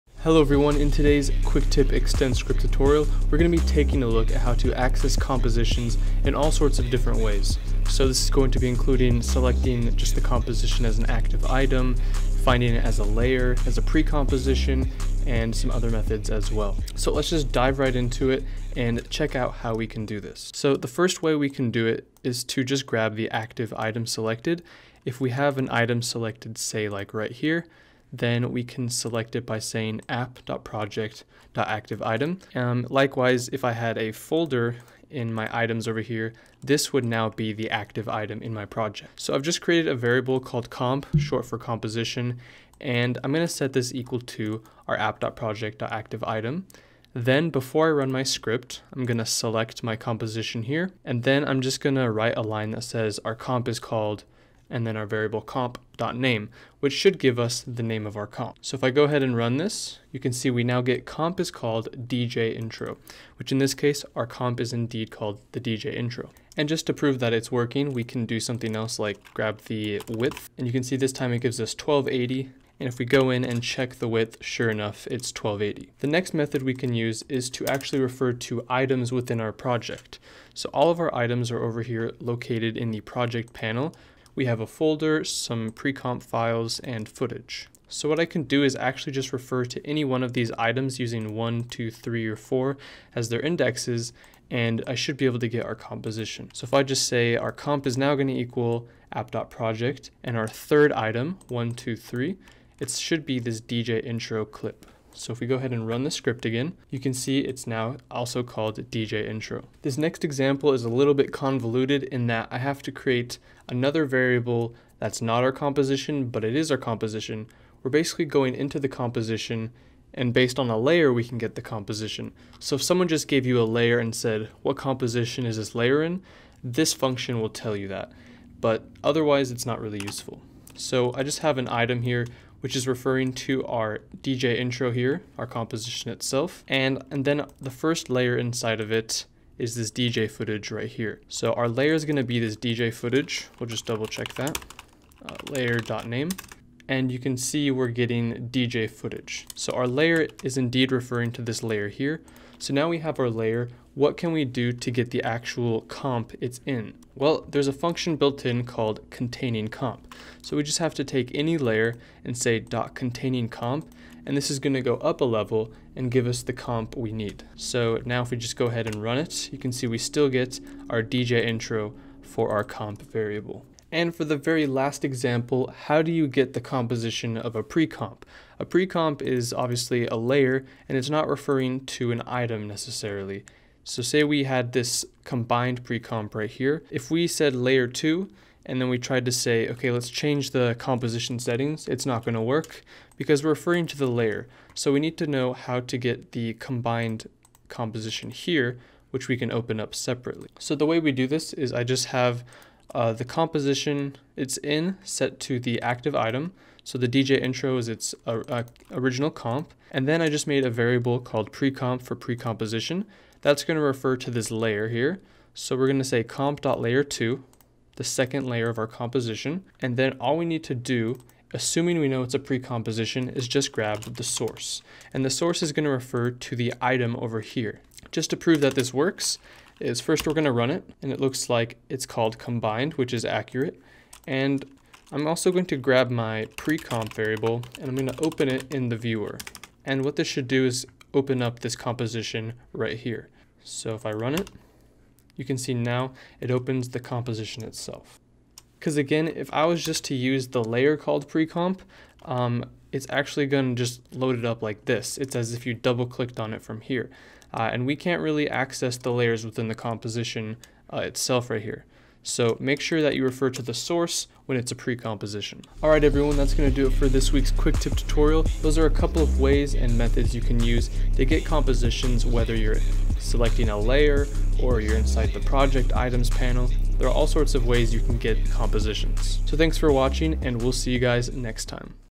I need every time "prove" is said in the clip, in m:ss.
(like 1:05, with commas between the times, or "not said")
1:06, 3:48.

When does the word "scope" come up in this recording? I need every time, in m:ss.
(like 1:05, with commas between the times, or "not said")
not said.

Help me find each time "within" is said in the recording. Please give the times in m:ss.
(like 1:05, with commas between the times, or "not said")
1:19, 4:19.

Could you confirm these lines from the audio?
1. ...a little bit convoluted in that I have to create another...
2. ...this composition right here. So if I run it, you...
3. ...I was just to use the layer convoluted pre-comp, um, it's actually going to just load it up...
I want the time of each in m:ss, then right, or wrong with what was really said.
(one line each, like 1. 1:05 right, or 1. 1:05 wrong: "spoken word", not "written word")
1. 1:50 right
2. 4:01 right
3. 4:09 wrong: "called", not "convoluted".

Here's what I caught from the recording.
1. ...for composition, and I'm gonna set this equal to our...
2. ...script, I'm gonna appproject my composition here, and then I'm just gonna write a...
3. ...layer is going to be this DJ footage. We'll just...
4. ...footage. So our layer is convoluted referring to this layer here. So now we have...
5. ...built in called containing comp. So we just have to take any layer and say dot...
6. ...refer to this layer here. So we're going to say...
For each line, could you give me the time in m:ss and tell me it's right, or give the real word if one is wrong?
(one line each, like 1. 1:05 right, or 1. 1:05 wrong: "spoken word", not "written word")
1. 0:41 right
2. 0:48 wrong: "select", not "appproject"
3. 2:21 right
4. 2:28 wrong: "indeed", not "convoluted"
5. 2:38 right
6. 3:33 right.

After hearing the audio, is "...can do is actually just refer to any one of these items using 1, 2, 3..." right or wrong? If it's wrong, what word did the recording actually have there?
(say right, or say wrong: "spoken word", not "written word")
right.